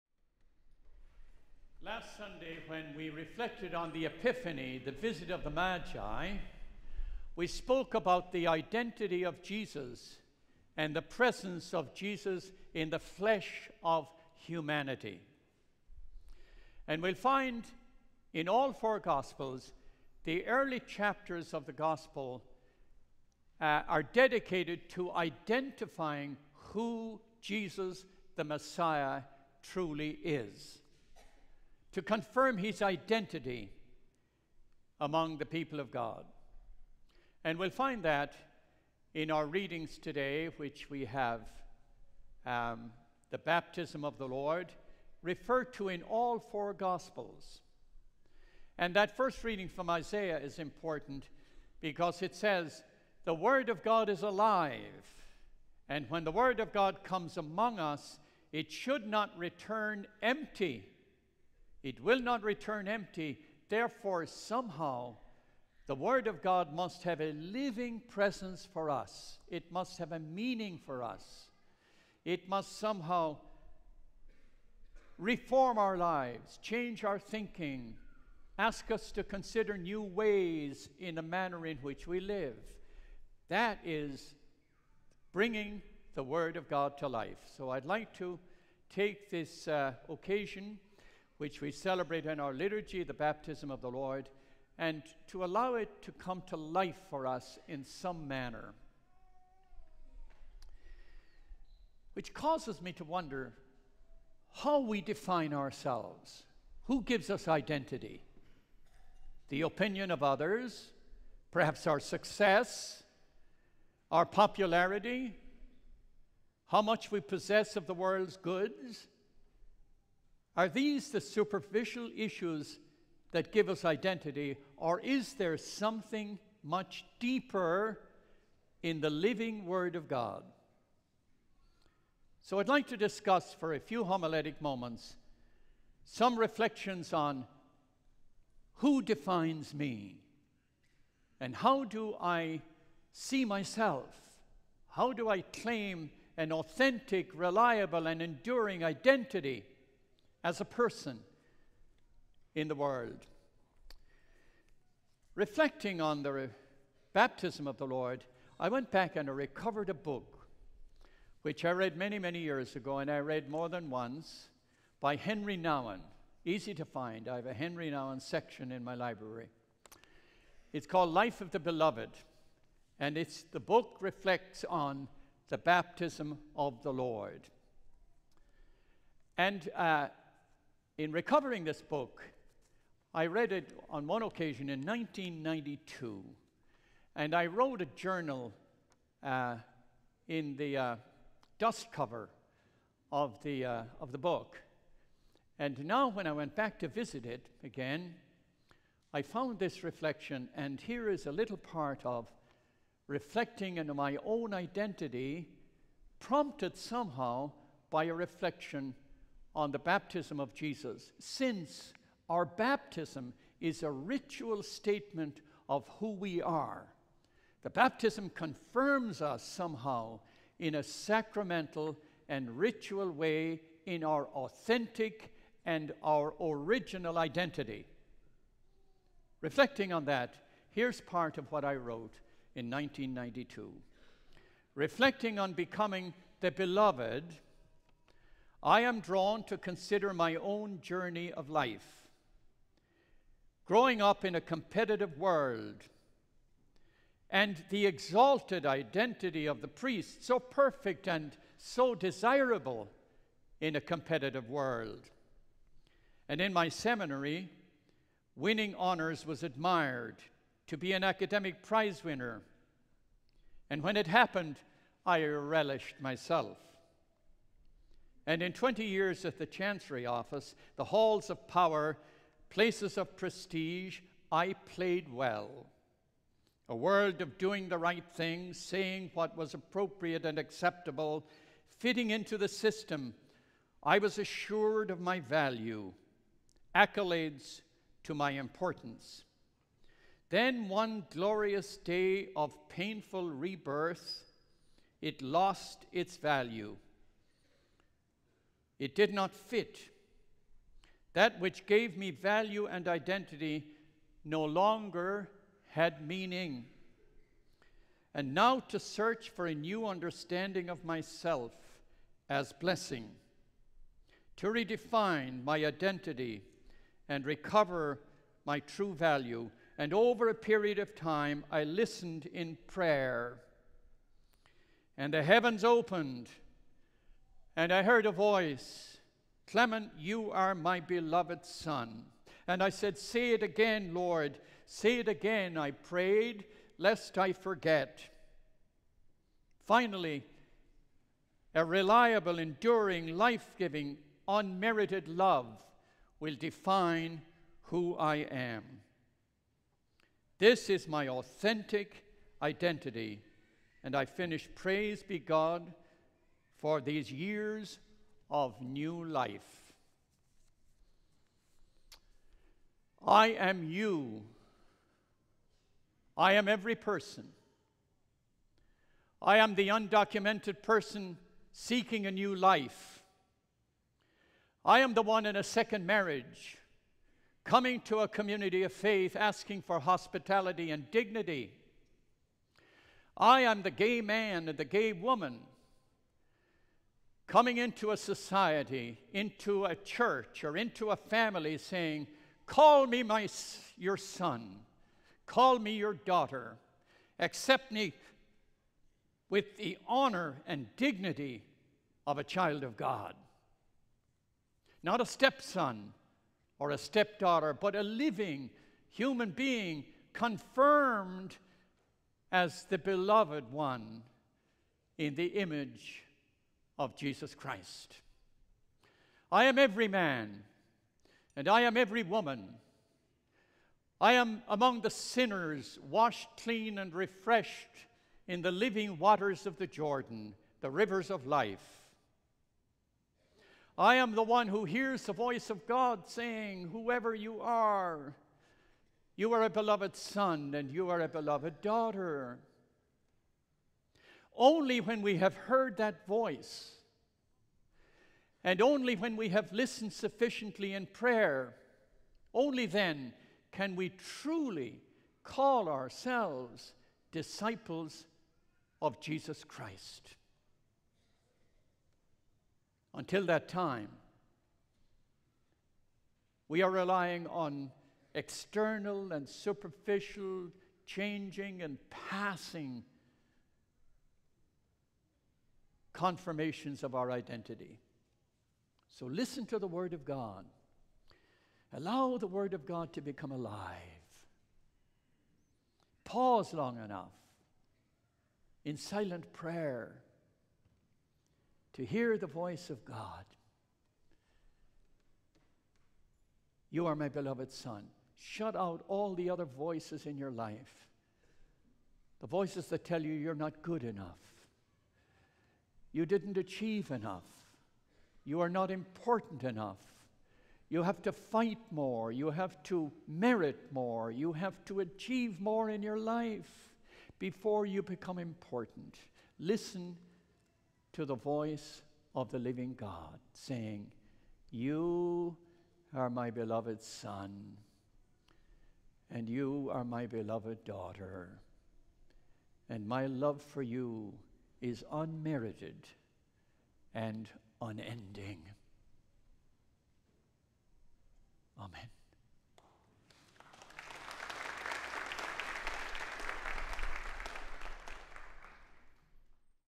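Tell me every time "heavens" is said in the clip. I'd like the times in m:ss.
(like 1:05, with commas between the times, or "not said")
5:25.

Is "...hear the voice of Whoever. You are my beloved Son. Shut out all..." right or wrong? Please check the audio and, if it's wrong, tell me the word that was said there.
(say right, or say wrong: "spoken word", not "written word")
wrong: "God", not "Whoever".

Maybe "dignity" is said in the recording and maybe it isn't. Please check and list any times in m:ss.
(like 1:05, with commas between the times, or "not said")
6:20, 6:40.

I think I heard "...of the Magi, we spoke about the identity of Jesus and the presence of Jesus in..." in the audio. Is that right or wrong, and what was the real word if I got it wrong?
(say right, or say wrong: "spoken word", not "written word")
right.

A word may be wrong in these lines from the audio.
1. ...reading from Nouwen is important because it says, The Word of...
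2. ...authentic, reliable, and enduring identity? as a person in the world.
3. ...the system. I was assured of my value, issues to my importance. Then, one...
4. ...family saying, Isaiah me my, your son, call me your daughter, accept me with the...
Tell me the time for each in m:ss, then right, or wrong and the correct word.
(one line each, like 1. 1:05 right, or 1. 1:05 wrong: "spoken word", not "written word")
1. 0:49 wrong: "Isaiah", not "Nouwen"
2. 2:26 right
3. 4:42 wrong: "accolades", not "issues"
4. 6:30 wrong: "Call", not "Isaiah".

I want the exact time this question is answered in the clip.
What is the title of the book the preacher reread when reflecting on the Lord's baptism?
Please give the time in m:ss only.
2:51.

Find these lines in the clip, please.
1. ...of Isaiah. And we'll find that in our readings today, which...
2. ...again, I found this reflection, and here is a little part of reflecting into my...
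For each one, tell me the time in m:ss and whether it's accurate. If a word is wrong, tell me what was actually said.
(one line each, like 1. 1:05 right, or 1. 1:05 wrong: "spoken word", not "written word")
1. 0:35 wrong: "God", not "Isaiah"
2. 3:17 right.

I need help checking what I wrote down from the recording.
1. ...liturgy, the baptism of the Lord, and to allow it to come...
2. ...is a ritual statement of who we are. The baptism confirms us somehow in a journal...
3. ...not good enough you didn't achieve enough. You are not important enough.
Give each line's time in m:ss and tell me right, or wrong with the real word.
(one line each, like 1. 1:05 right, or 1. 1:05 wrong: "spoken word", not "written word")
1. 1:32 right
2. 3:33 wrong: "sacramental", not "journal"
3. 8:23 right.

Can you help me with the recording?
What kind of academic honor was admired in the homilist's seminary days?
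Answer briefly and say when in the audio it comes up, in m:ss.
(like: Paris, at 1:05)
academic prize, at 4:21.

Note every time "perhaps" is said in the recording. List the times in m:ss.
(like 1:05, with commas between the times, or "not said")
1:51.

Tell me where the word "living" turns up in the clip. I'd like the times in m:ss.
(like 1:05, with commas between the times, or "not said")
1:07, 2:09, 6:47, 7:08, 8:42.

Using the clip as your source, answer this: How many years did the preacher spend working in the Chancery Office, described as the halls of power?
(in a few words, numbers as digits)
20.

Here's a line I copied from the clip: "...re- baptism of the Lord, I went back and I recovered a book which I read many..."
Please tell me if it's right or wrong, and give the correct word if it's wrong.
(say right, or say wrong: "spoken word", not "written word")
right.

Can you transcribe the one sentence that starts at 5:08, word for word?
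And now to search for a new understanding of myself as blessing, to redefine my identity and recover my true value.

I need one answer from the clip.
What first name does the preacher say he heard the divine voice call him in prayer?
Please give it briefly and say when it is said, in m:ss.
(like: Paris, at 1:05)
Clement, at 5:29.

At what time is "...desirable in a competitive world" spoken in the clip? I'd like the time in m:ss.
4:11.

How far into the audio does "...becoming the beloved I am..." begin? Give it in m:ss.
3:55.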